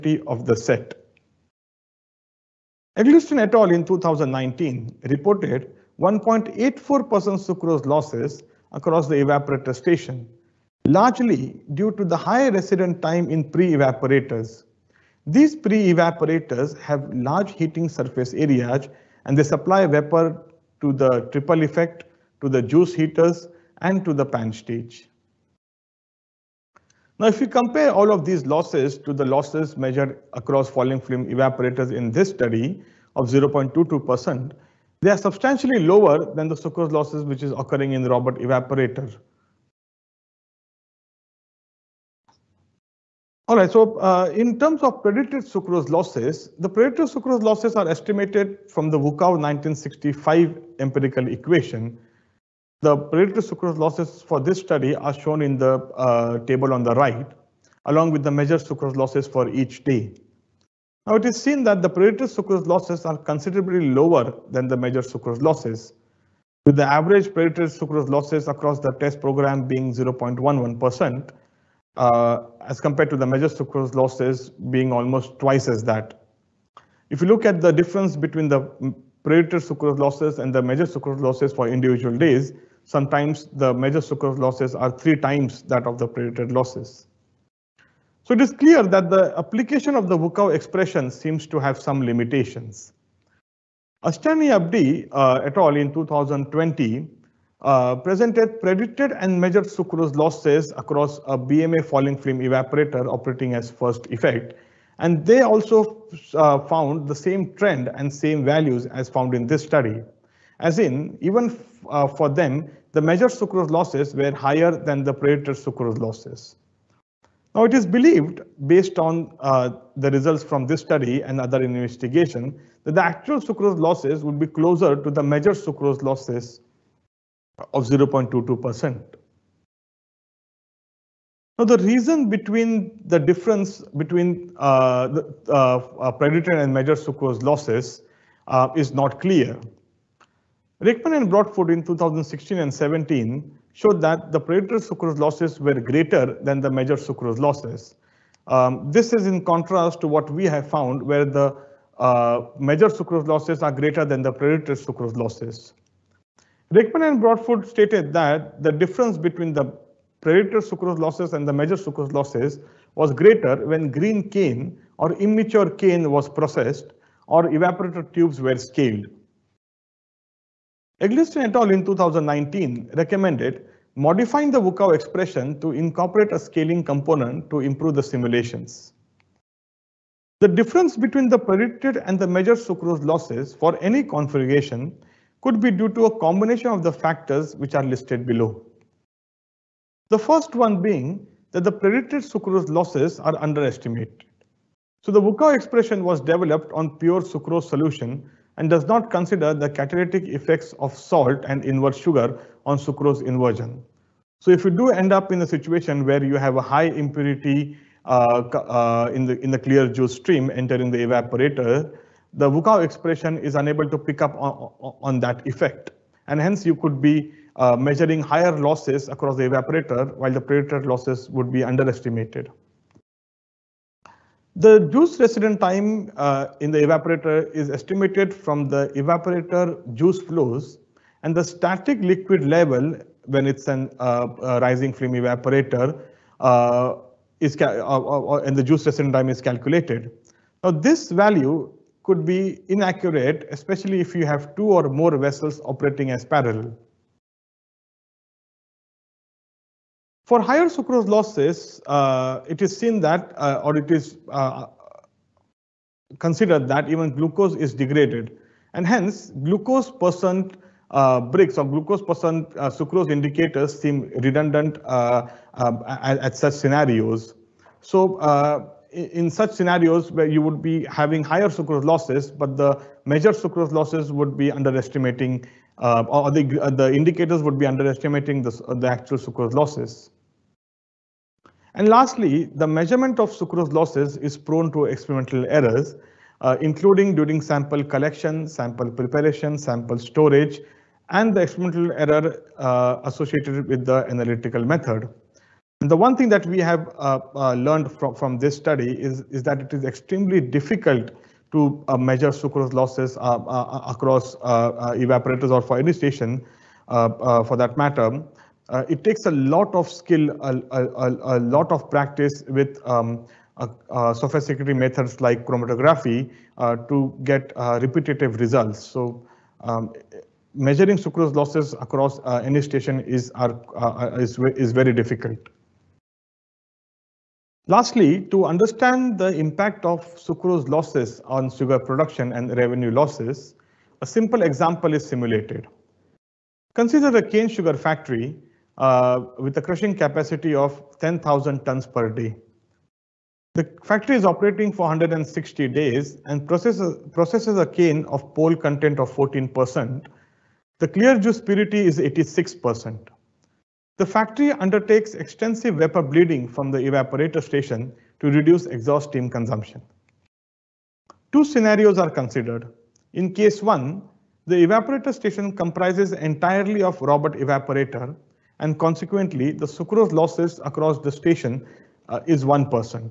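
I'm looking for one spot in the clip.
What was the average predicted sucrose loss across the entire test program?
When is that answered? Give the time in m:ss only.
1:09.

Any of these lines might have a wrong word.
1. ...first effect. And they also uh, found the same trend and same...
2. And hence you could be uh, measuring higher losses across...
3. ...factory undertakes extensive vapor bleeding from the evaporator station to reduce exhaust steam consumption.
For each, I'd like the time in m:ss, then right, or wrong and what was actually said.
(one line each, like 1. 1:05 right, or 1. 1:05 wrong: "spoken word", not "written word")
1. 1:43 right
2. 3:36 right
3. 5:54 right.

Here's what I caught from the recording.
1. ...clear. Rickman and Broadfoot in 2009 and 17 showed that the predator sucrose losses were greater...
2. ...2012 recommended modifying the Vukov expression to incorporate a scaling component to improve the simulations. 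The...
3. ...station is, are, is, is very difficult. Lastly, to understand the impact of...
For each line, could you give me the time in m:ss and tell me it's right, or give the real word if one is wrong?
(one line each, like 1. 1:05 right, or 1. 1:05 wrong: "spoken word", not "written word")
1. 2:19 wrong: "2016", not "2009"
2. 2:51 wrong: "2019", not "2012"
3. 5:22 right.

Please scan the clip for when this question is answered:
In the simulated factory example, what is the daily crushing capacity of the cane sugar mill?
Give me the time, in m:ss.
5:41.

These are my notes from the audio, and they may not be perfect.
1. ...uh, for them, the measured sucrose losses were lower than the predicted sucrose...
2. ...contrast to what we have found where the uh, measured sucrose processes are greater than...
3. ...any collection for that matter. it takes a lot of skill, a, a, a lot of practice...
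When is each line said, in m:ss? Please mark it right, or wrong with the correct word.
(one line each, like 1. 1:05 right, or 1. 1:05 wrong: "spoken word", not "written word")
1. 1:51 wrong: "higher", not "lower"
2. 2:29 wrong: "losses", not "processes"
3. 5:05 wrong: "station", not "collection".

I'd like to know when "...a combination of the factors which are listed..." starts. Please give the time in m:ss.
3:06.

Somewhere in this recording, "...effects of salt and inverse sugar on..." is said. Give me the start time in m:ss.
3:20.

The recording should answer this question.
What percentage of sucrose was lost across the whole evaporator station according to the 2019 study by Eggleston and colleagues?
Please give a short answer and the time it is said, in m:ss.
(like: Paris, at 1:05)
1.84%, at 0:06.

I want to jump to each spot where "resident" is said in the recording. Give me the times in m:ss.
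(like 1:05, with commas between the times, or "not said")
0:12, 3:45, 3:58.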